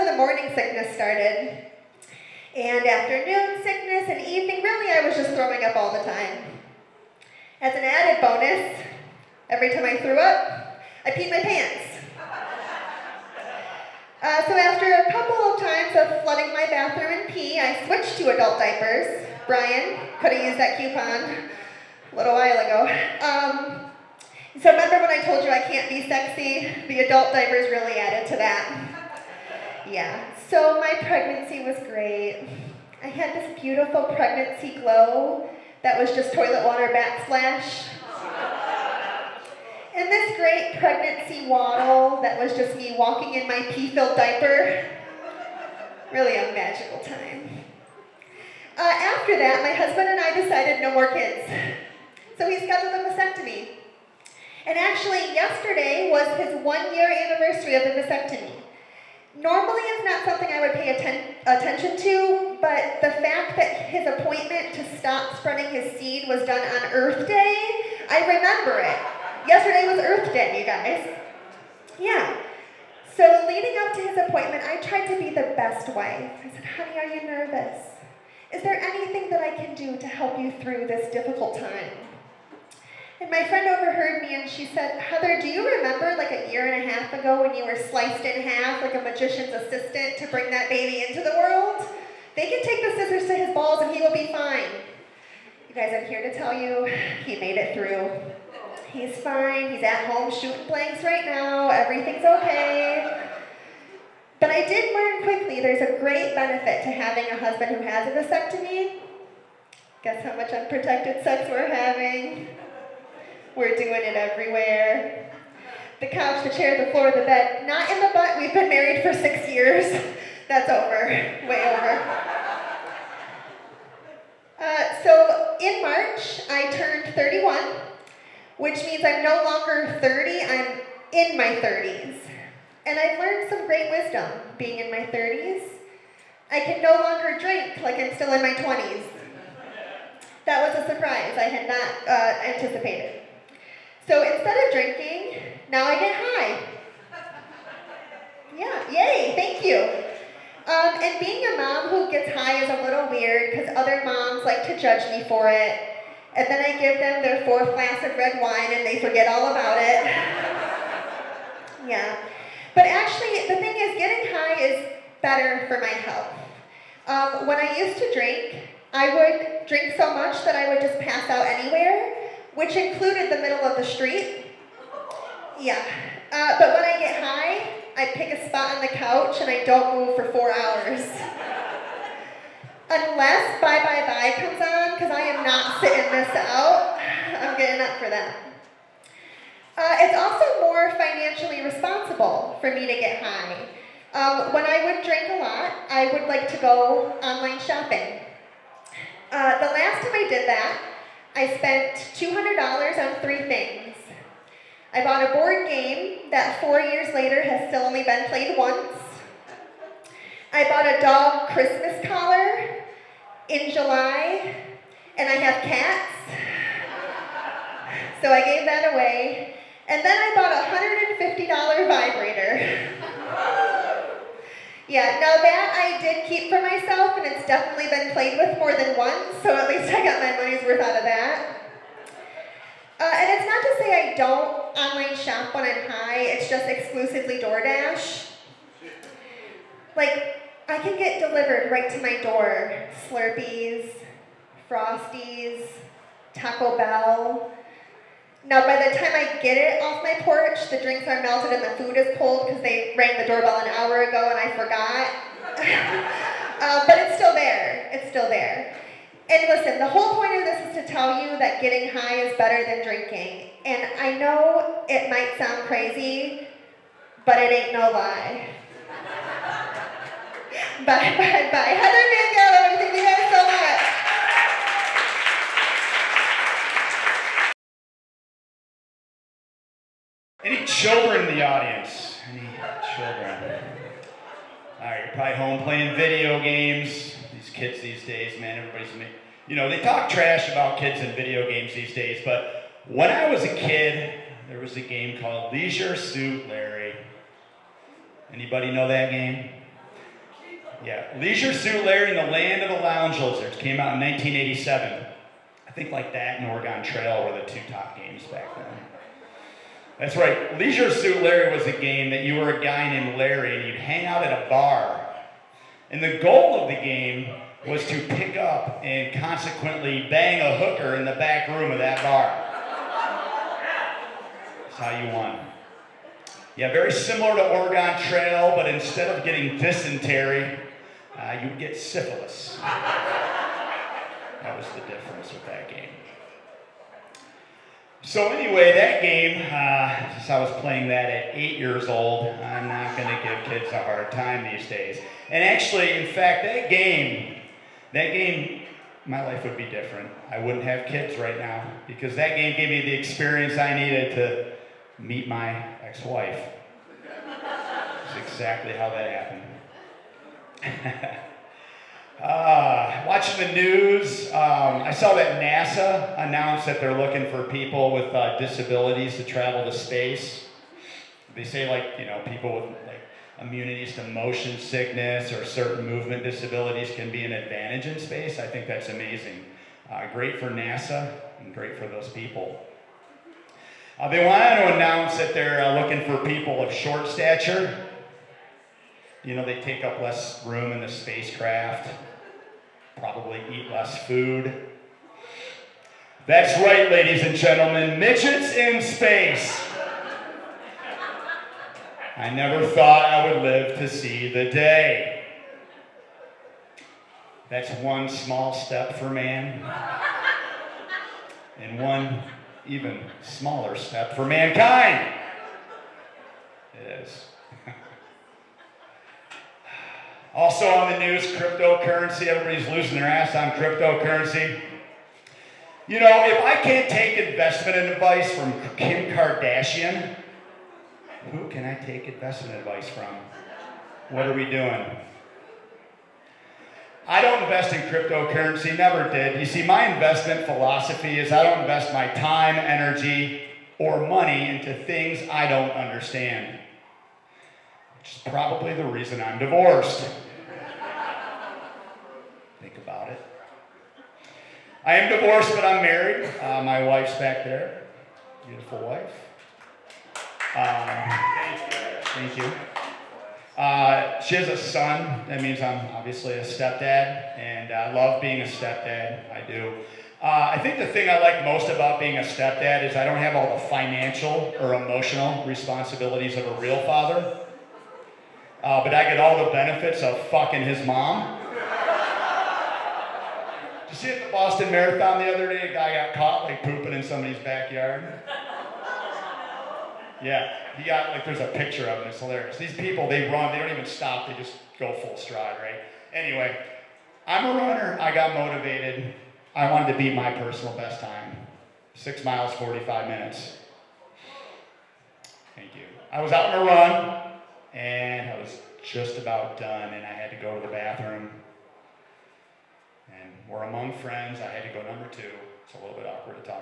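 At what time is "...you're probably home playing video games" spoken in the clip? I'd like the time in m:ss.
4:45.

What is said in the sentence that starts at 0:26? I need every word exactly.
The adult diapers really added to that.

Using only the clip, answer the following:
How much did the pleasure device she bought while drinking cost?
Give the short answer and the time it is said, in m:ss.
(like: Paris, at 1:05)
$150, at 3:40.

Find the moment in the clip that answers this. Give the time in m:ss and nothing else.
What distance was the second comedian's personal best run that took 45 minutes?
8:21.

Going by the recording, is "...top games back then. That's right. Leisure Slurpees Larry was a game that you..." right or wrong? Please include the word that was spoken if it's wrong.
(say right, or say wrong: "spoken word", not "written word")
wrong: "Suit", not "Slurpees".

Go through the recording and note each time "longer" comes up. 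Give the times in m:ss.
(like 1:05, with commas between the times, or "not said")
2:09, 2:17.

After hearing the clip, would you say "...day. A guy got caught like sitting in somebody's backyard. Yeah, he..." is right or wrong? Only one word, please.
wrong.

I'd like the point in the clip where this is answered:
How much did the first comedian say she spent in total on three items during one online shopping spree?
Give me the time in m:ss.
3:22.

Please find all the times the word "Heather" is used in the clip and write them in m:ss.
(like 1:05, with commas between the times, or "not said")
1:25, 4:31.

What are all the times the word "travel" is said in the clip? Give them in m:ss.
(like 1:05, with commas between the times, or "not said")
6:09.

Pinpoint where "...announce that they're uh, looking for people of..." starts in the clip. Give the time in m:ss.
6:24.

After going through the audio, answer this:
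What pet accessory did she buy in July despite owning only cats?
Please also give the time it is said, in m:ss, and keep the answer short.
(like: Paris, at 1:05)
dog Christmas collar, at 3:30.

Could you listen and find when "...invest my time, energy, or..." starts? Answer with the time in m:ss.
7:21.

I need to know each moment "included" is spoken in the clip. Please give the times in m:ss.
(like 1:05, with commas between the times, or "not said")
2:52.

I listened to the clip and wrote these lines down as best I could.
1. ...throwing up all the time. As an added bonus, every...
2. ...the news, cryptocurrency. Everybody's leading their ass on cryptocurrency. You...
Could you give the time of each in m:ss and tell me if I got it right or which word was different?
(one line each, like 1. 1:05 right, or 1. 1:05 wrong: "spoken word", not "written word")
1. 0:05 right
2. 7:00 wrong: "losing", not "leading".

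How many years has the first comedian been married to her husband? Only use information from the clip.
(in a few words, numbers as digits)
6.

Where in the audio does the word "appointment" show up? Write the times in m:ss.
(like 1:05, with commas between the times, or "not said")
1:04, 1:14.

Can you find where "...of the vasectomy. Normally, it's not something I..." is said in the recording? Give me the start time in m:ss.
0:57.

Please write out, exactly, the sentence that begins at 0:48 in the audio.
Uh, after that, my husband and I decided no more kids.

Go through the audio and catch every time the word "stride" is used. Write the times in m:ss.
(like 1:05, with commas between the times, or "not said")
8:15.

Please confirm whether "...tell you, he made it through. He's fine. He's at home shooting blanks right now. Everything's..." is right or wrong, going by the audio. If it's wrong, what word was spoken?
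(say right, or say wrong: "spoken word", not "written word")
right.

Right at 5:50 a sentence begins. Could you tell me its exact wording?
I wouldn't have kids right now because that game gave me the experience I needed to meet my ex-wife.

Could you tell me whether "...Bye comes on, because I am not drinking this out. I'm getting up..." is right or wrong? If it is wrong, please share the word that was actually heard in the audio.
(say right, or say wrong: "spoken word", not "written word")
wrong: "sitting", not "drinking".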